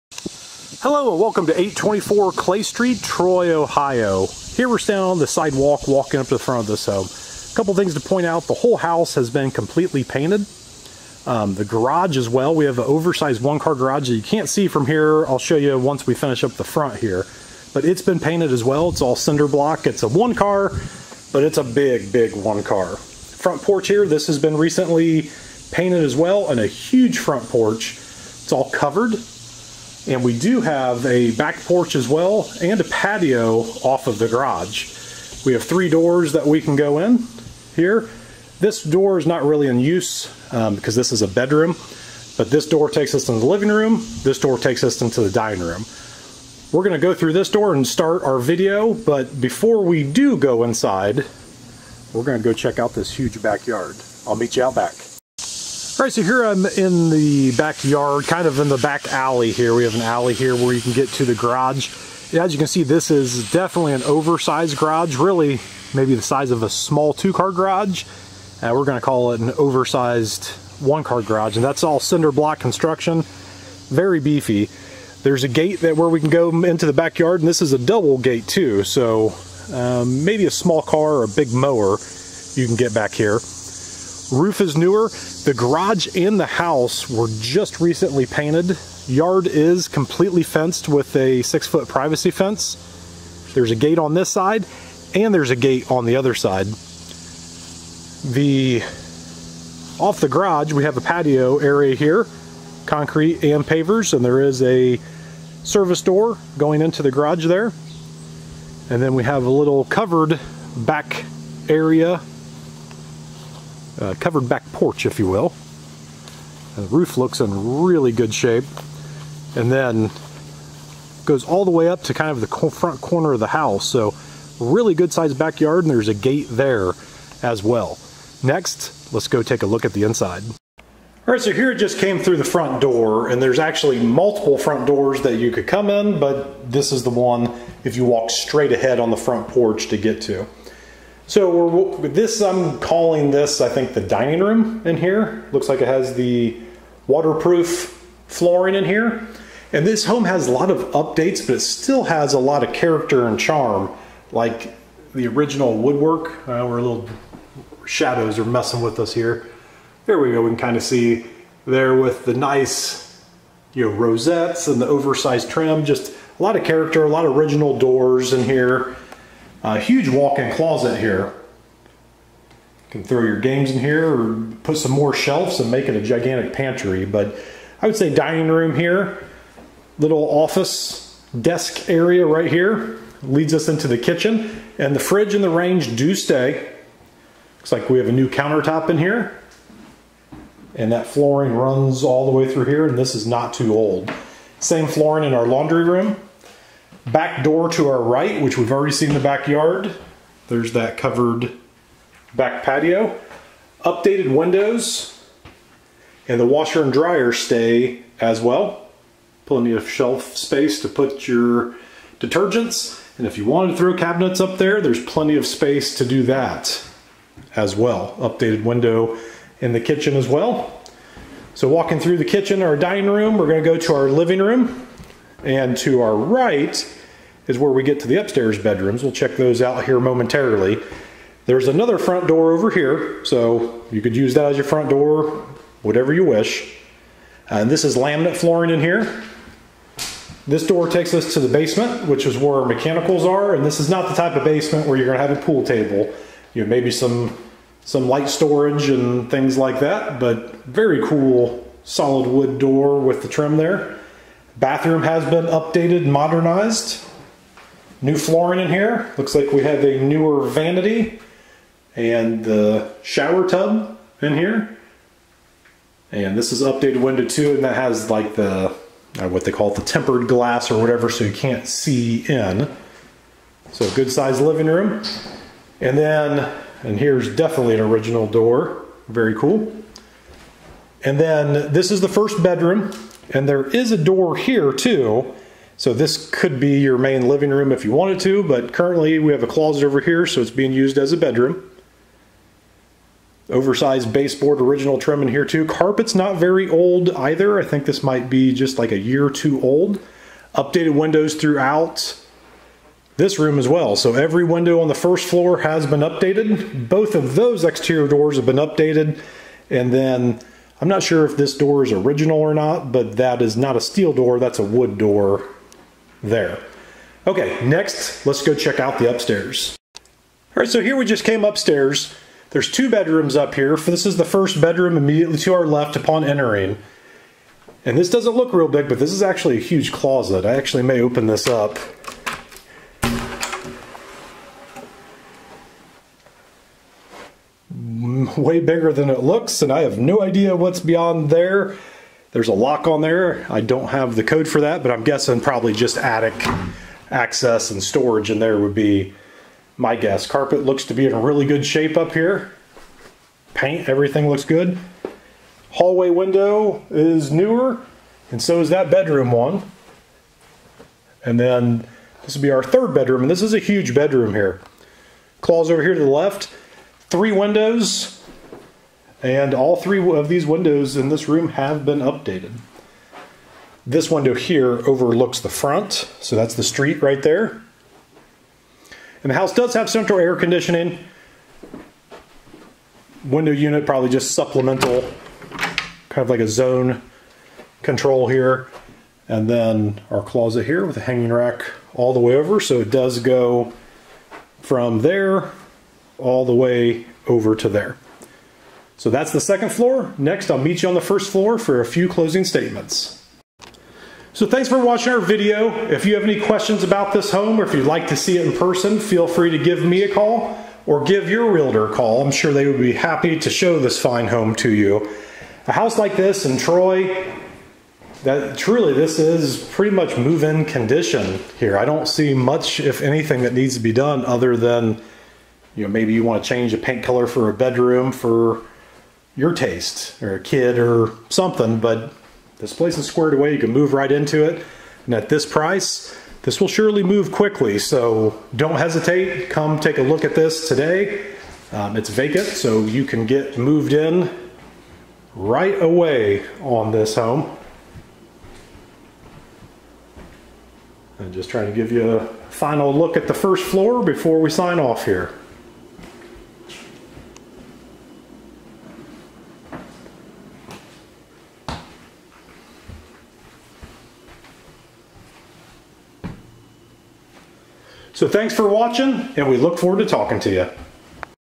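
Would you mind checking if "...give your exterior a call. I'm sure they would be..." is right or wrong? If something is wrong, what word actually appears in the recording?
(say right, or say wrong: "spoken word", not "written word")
wrong: "realtor", not "exterior".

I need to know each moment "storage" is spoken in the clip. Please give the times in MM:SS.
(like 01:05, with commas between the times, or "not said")
04:08, 05:47.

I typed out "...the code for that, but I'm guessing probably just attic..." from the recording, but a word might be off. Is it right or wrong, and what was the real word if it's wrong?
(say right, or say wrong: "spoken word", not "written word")
right.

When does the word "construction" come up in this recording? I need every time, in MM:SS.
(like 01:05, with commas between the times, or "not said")
01:12.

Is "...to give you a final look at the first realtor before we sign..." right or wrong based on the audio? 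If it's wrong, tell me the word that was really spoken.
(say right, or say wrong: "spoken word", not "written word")
wrong: "floor", not "realtor".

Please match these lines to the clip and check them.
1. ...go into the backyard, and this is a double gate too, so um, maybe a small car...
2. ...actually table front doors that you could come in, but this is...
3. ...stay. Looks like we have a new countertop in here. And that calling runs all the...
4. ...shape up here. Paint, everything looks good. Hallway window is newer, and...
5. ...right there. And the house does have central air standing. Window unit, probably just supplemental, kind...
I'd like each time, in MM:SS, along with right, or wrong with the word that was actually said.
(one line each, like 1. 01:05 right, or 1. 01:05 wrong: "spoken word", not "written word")
1. 01:16 right
2. 02:13 wrong: "multiple", not "table"
3. 03:06 wrong: "flooring", not "calling"
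4. 05:51 right
5. 06:17 wrong: "conditioning", not "standing".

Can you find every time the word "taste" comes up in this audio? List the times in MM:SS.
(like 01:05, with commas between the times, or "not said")
07:09.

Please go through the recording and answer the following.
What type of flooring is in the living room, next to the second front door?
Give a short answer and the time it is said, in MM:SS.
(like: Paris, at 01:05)
Laminate, at 03:57.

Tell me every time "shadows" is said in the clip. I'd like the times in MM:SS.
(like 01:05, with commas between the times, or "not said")
02:37.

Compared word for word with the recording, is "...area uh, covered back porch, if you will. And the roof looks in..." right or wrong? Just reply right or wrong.
right.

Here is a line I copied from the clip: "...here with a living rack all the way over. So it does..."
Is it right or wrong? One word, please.
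wrong.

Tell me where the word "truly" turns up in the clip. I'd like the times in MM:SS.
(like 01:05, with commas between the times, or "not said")
06:58.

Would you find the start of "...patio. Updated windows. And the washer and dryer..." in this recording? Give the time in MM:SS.
03:22.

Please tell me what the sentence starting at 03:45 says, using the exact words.
And to our right is where we get to the upstairs bedrooms.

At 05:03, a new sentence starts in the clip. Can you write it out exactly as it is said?
So every window on the first floor has been updated.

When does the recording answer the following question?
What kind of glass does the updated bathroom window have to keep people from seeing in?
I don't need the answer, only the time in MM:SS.
04:29.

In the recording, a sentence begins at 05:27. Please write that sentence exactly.
And this doesn't look real big, but this is actually a huge closet.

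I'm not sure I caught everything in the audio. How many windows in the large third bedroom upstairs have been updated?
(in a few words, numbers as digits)
3.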